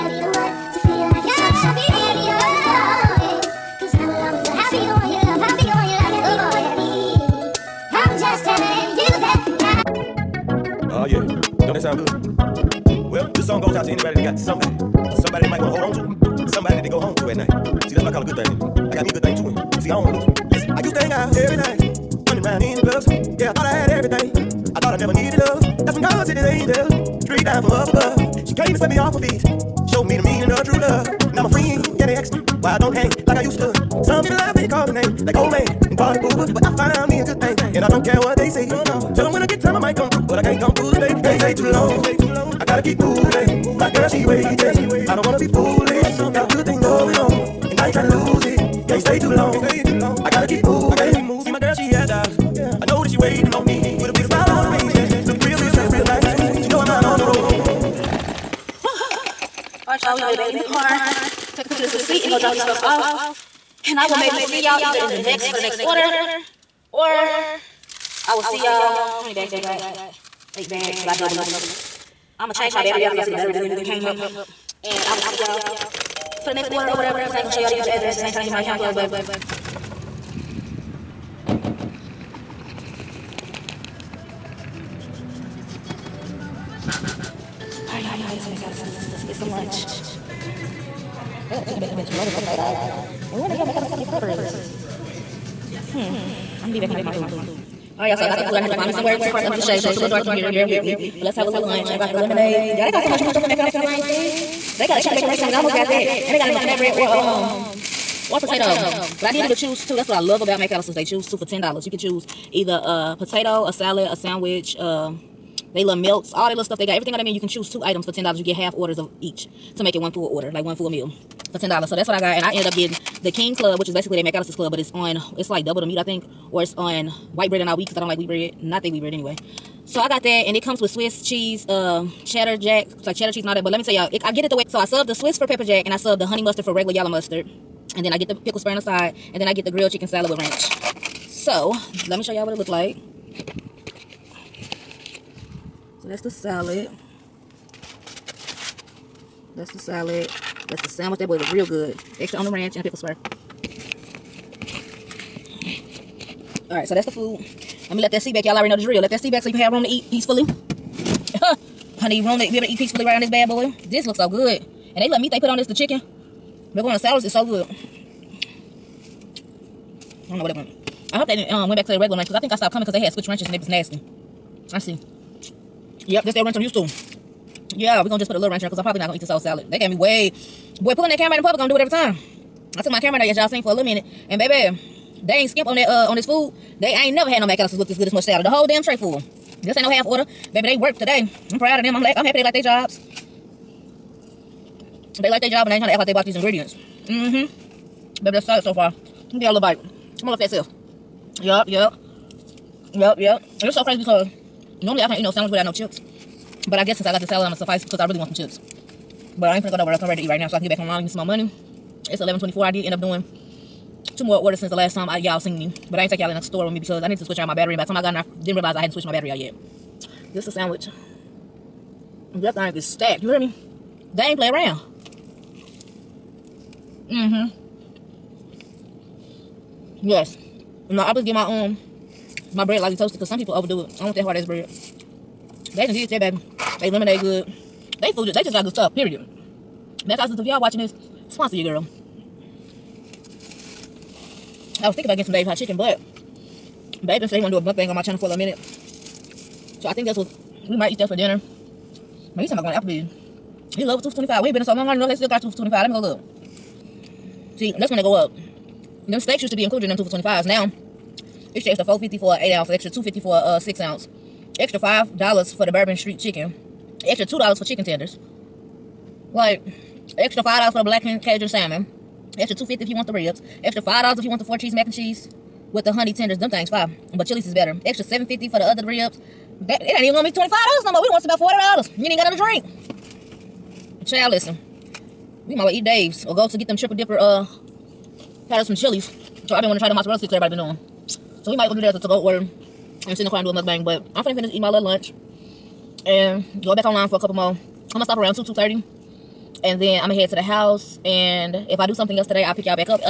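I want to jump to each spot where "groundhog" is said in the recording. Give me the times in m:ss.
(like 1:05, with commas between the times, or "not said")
not said.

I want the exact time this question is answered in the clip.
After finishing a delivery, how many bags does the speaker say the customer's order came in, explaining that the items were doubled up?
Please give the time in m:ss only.
1:10.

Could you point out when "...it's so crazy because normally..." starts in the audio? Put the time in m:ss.
3:23.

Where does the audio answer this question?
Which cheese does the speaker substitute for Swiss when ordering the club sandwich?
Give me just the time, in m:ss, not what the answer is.
2:15.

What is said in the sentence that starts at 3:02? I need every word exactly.
I took my camera now, as y'all seen for a little minute.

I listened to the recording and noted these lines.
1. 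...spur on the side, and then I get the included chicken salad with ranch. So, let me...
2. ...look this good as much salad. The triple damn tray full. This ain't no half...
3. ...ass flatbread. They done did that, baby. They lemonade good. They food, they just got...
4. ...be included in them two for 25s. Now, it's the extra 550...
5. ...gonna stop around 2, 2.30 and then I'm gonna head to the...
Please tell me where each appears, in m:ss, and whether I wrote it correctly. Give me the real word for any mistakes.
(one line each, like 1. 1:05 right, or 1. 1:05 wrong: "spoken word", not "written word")
1. 2:18 wrong: "grilled", not "included"
2. 3:07 wrong: "whole", not "triple"
3. 3:54 wrong: "bread", not "flatbread"
4. 4:19 wrong: "450", not "550"
5. 4:57 right.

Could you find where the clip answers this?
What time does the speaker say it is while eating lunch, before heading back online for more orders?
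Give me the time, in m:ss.
3:32.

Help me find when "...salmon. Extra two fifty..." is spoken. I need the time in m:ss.
4:31.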